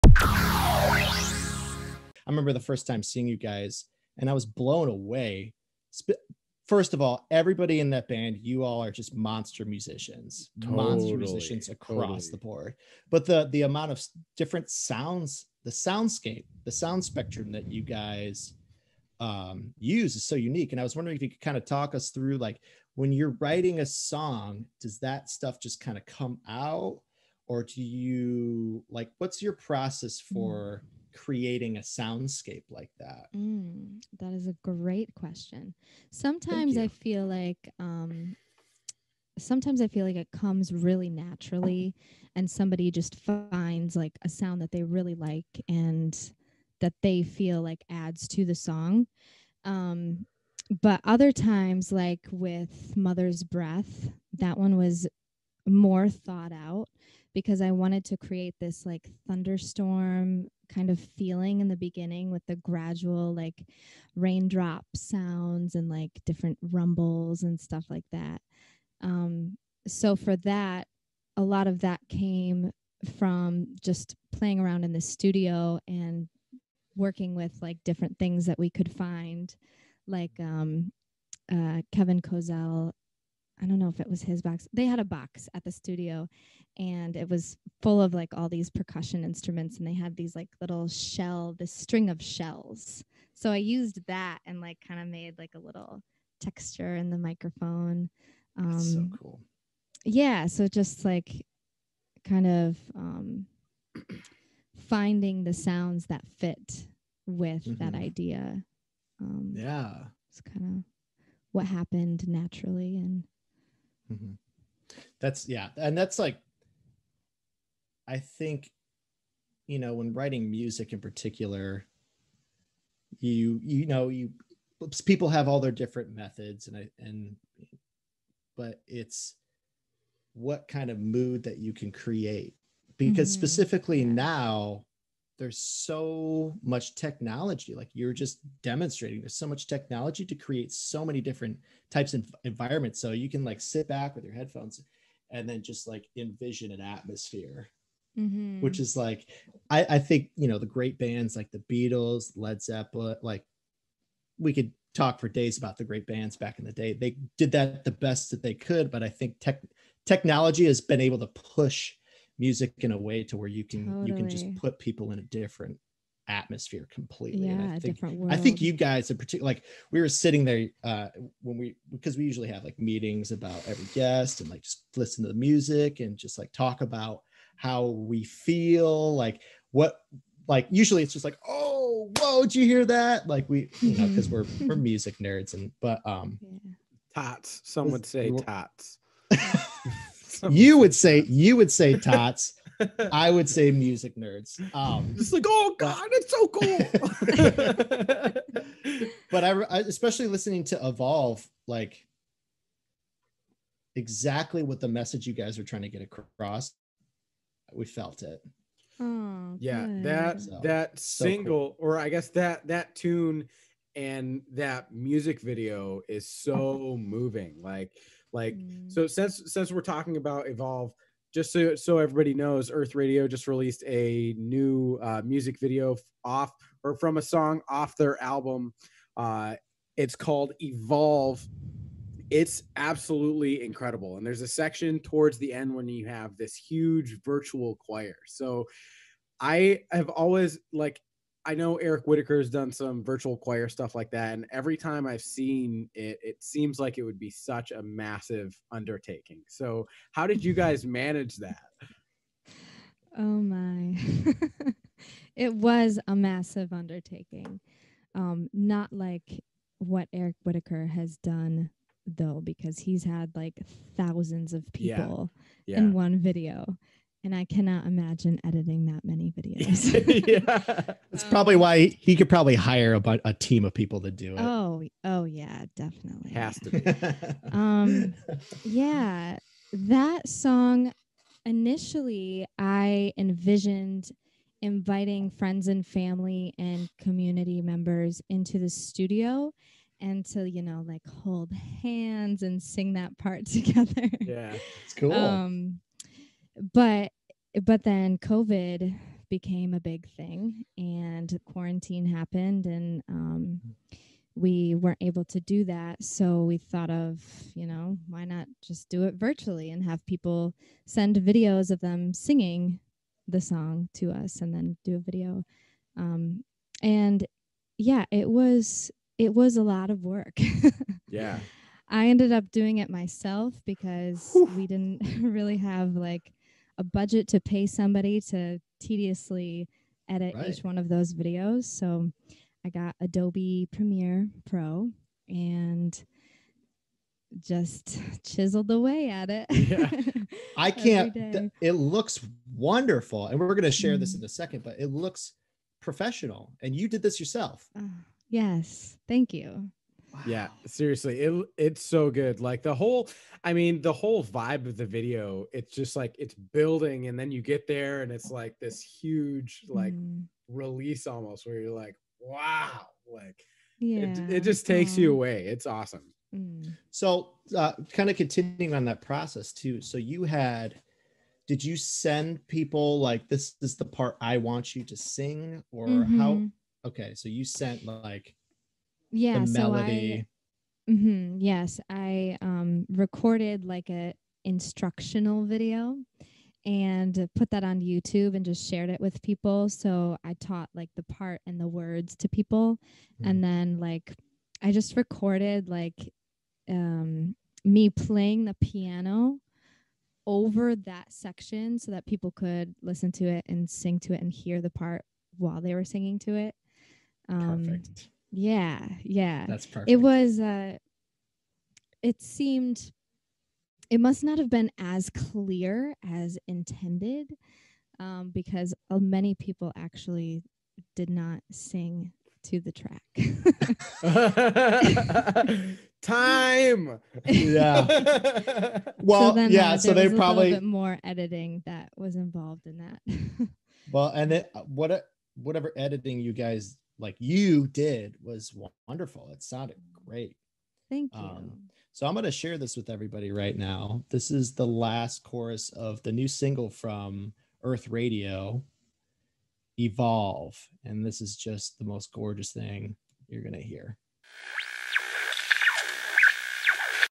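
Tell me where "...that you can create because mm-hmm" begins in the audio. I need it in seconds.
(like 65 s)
131 s.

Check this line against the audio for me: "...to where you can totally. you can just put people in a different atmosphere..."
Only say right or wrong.
right.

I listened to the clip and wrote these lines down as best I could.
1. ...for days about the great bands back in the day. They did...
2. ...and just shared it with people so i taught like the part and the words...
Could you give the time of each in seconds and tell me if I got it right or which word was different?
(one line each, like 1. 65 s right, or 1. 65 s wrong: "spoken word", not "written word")
1. 155 s right
2. 388 s right.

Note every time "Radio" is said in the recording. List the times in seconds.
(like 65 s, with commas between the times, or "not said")
222 s, 447 s.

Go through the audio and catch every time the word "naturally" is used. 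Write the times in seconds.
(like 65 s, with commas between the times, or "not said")
41 s, 112 s.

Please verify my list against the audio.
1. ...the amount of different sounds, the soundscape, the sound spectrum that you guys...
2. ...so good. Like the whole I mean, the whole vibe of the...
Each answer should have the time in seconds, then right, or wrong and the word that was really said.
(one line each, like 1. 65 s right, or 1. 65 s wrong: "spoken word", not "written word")
1. 13 s right
2. 351 s right.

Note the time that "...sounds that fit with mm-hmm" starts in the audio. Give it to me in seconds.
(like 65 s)
105 s.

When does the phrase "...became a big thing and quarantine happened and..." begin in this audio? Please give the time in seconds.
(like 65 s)
299 s.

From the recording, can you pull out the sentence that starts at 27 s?
or do you like what's your process hmm.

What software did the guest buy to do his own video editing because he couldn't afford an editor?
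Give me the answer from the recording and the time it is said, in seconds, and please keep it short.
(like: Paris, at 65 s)
Adobe Premiere Pro, at 332 s.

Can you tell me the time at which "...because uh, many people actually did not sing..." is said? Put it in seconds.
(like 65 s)
418 s.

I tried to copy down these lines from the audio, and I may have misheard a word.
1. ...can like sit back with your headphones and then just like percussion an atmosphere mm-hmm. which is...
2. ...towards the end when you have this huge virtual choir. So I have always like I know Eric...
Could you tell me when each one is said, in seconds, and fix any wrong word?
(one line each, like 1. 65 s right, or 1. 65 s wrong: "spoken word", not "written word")
1. 143 s wrong: "envision", not "percussion"
2. 234 s right.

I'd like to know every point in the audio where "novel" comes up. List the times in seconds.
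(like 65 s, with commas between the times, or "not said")
not said.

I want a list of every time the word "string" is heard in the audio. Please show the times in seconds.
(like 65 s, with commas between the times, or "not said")
91 s.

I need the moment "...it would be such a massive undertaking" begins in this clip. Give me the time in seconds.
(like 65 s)
246 s.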